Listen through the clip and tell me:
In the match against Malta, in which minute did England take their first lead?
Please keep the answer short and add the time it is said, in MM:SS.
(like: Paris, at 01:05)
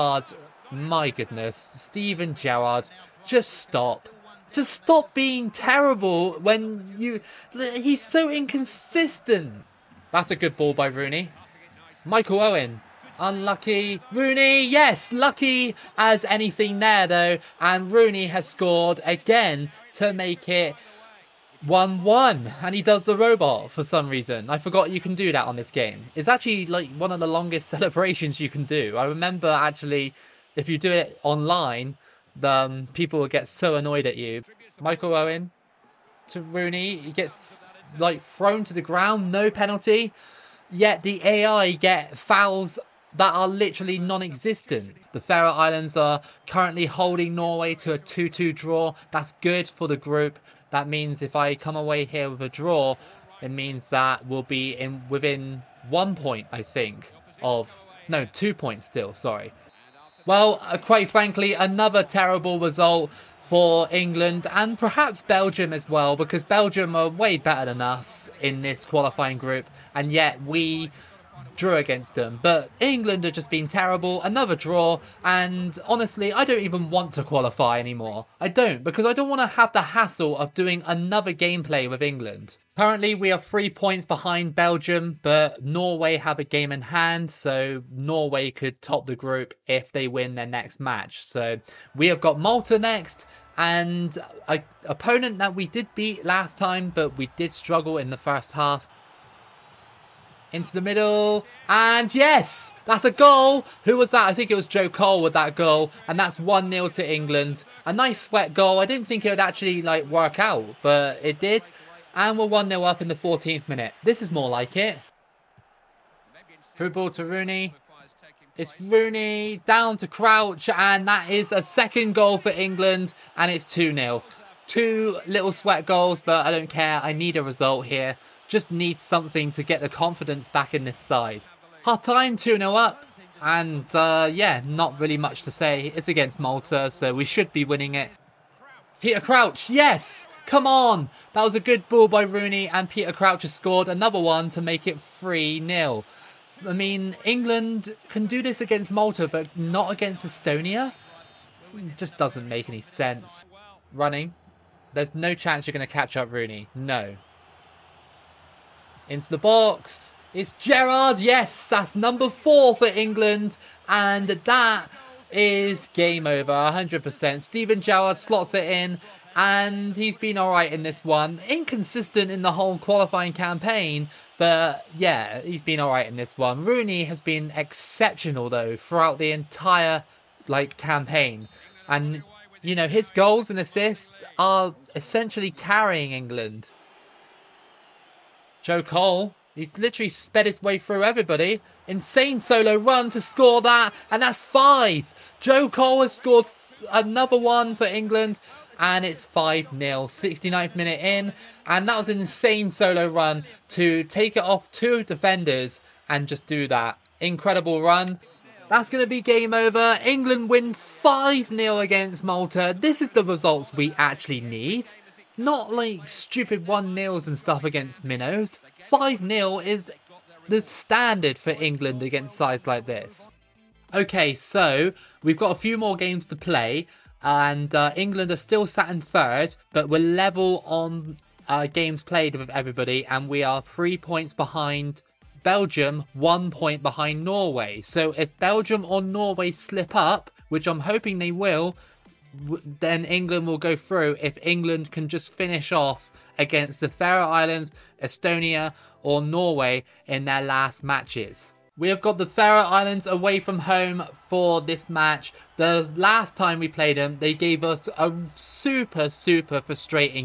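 14th minute, at 01:53.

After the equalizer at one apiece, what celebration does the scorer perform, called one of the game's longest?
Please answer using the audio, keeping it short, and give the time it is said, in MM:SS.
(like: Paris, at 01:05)
The robot, at 00:23.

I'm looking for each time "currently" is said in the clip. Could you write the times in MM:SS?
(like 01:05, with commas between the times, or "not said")
00:46, 01:22.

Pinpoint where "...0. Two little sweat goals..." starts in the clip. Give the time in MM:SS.
02:03.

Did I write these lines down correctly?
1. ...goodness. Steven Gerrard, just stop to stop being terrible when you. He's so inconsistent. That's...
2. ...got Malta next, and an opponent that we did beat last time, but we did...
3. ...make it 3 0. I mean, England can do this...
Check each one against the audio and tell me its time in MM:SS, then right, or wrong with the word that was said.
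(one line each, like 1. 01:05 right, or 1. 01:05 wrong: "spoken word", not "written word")
1. 00:01 right
2. 01:32 right
3. 02:24 right.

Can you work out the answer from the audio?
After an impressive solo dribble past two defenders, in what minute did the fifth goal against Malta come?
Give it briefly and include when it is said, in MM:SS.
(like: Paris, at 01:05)
69th minute, at 03:20.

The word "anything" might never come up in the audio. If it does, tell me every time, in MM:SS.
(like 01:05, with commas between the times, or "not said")
00:16.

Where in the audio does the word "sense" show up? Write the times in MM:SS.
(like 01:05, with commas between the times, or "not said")
02:32.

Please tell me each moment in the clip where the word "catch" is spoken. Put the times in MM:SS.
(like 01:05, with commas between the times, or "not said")
02:35.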